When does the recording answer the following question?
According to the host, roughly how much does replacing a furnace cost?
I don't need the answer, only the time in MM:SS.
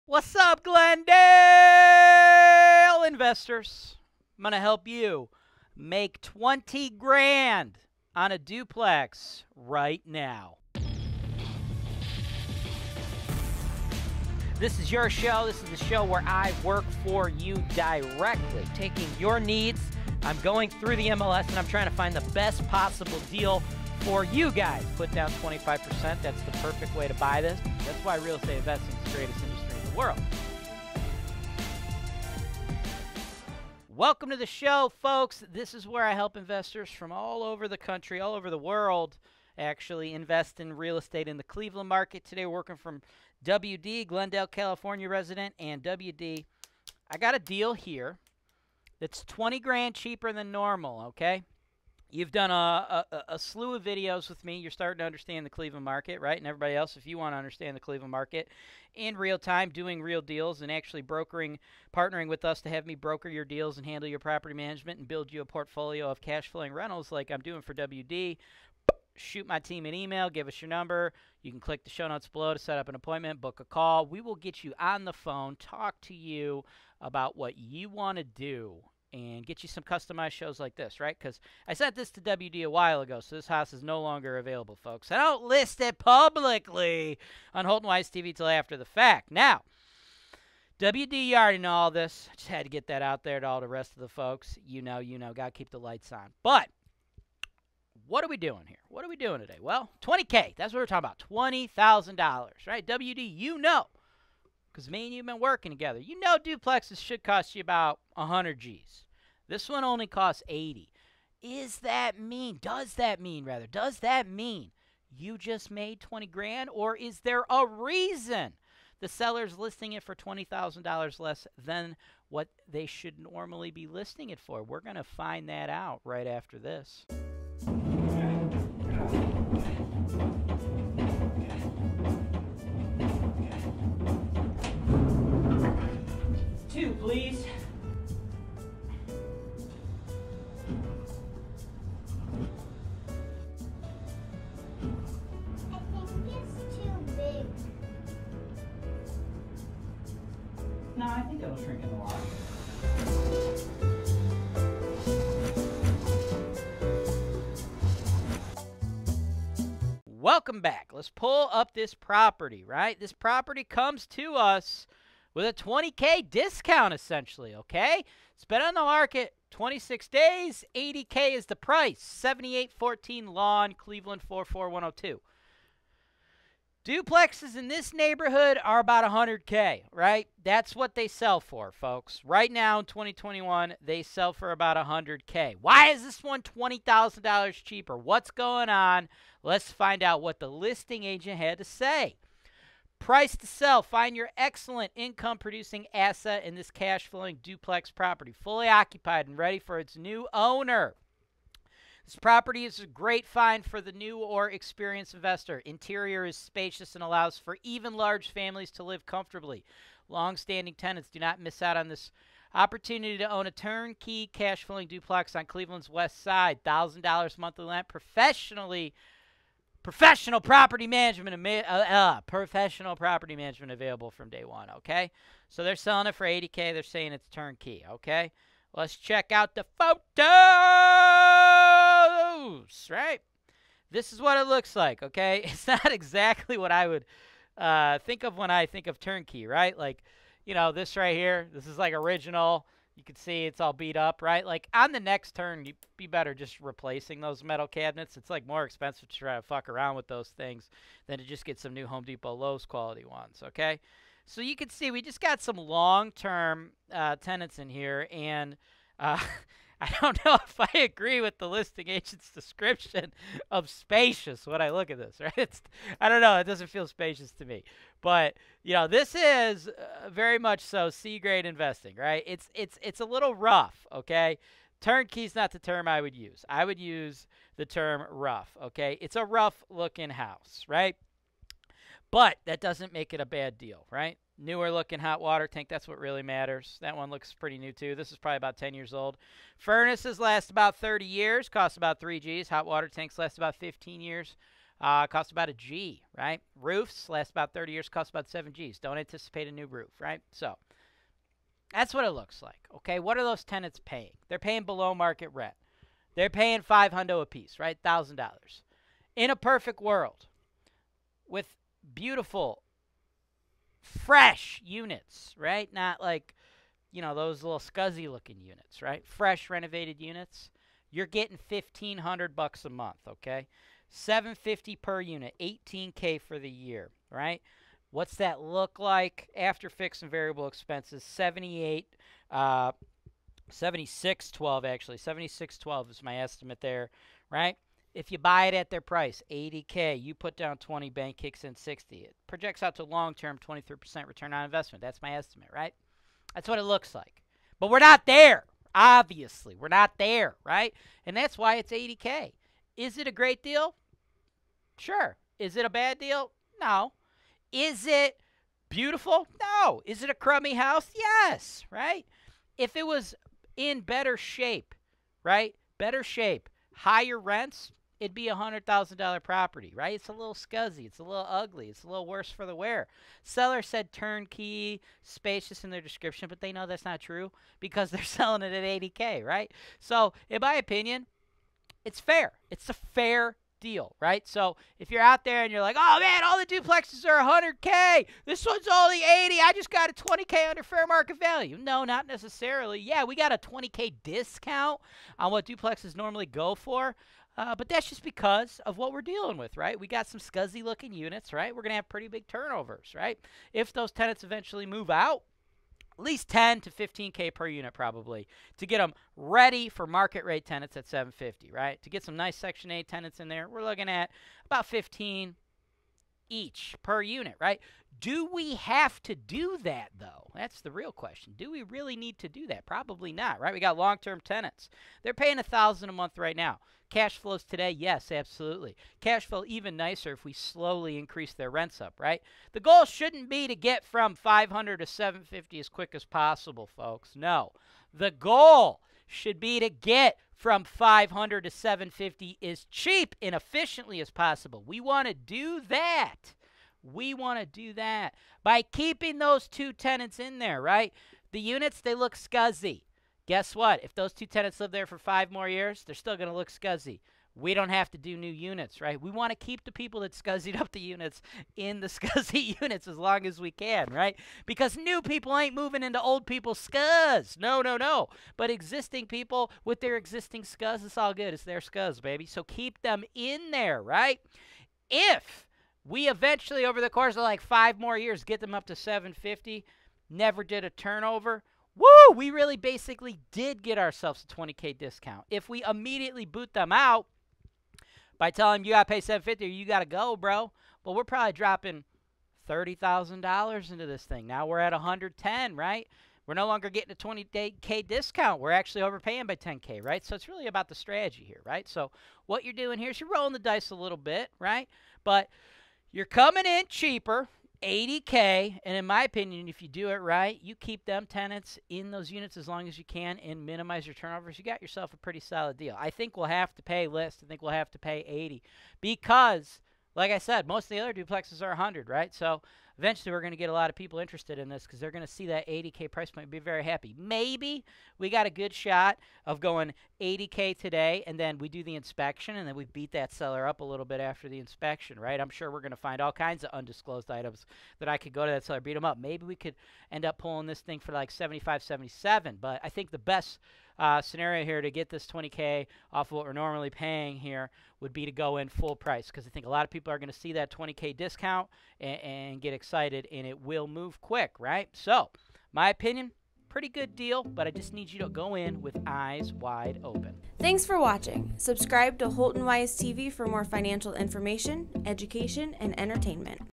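04:52.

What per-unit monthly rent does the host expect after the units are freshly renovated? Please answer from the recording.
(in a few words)
$750.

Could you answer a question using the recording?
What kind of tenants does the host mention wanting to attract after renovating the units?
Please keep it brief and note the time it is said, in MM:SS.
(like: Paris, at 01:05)
Section 8, at 06:52.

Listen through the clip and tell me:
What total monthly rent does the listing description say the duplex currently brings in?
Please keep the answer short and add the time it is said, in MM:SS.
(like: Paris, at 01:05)
$1,000, at 03:36.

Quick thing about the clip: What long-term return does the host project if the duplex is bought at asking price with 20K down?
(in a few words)
23%.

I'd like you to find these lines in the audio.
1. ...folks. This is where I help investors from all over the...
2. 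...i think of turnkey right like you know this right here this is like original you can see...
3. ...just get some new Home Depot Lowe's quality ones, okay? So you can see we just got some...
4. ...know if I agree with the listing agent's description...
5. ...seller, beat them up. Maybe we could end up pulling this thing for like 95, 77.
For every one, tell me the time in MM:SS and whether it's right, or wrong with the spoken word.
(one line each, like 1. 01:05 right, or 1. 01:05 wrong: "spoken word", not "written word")
1. 00:35 right
2. 03:58 right
3. 04:11 right
4. 04:20 right
5. 08:58 wrong: "75", not "95".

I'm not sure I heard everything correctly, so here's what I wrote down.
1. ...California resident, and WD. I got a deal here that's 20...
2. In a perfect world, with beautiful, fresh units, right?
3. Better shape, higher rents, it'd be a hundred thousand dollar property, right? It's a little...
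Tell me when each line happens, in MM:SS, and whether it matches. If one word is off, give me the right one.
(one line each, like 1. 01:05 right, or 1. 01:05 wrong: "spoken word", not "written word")
1. 00:44 right
2. 05:09 right
3. 06:05 right.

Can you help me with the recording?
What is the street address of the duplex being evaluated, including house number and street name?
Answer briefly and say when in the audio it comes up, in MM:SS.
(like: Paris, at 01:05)
7814 Lawn, at 02:52.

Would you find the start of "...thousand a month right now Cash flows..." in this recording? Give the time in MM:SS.
07:05.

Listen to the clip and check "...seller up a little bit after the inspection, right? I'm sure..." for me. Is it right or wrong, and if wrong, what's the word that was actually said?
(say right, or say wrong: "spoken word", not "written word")
right.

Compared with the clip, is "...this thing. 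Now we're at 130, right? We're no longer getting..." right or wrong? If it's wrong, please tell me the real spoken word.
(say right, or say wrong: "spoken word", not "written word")
wrong: "110", not "130".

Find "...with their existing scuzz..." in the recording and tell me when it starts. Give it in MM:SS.
07:49.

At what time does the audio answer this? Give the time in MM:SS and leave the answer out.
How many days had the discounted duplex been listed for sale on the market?
02:49.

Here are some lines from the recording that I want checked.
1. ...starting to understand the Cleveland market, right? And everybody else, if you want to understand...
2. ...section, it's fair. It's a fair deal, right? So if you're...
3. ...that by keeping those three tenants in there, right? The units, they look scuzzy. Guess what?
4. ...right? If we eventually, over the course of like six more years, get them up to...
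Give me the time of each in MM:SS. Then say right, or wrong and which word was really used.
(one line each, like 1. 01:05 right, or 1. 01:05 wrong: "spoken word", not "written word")
1. 00:54 right
2. 06:20 wrong: "opinion", not "section"
3. 07:27 wrong: "two", not "three"
4. 07:53 wrong: "five", not "six".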